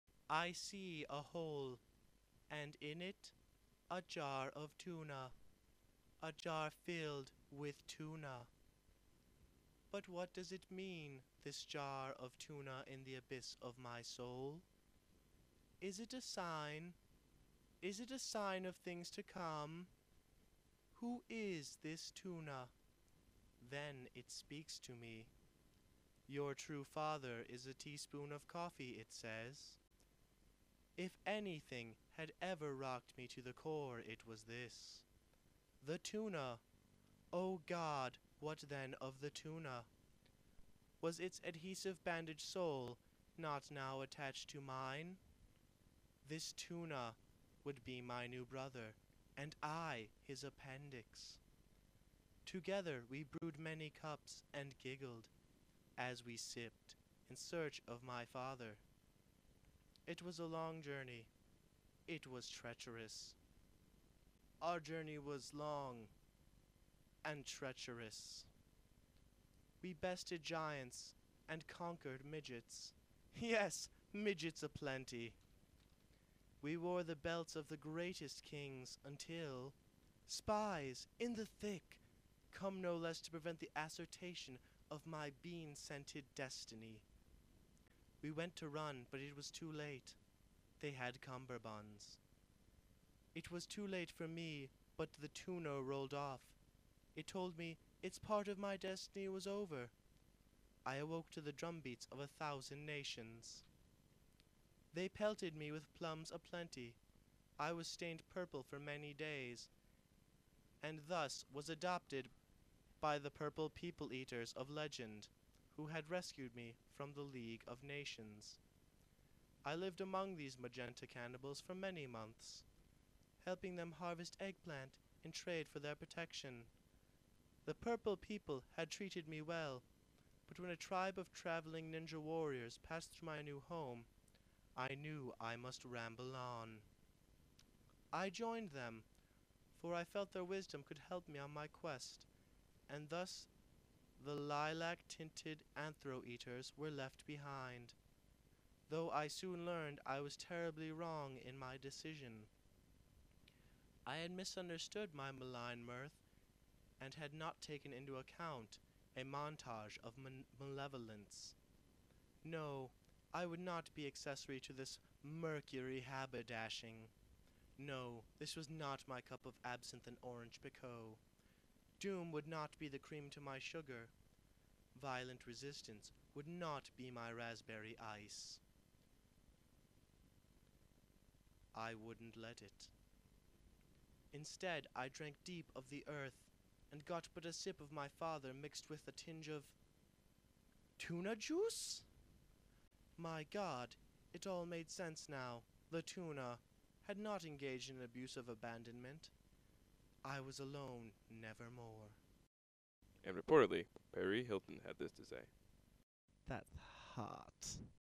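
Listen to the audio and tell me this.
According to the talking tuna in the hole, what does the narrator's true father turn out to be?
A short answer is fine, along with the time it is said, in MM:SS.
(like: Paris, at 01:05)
a teaspoon of coffee, at 00:27.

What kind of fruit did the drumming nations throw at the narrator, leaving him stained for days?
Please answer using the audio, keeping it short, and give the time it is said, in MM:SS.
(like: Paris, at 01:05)
plums, at 01:45.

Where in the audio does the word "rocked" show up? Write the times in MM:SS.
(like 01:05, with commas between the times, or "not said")
00:32.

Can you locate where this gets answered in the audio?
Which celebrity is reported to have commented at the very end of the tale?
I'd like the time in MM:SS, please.
03:24.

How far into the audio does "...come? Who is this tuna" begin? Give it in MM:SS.
00:19.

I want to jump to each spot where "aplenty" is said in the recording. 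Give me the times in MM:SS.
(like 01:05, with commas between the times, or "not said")
01:14, 01:46.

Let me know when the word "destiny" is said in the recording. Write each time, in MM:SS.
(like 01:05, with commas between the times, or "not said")
01:26, 01:38.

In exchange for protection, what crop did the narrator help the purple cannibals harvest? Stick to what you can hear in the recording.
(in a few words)
eggplant.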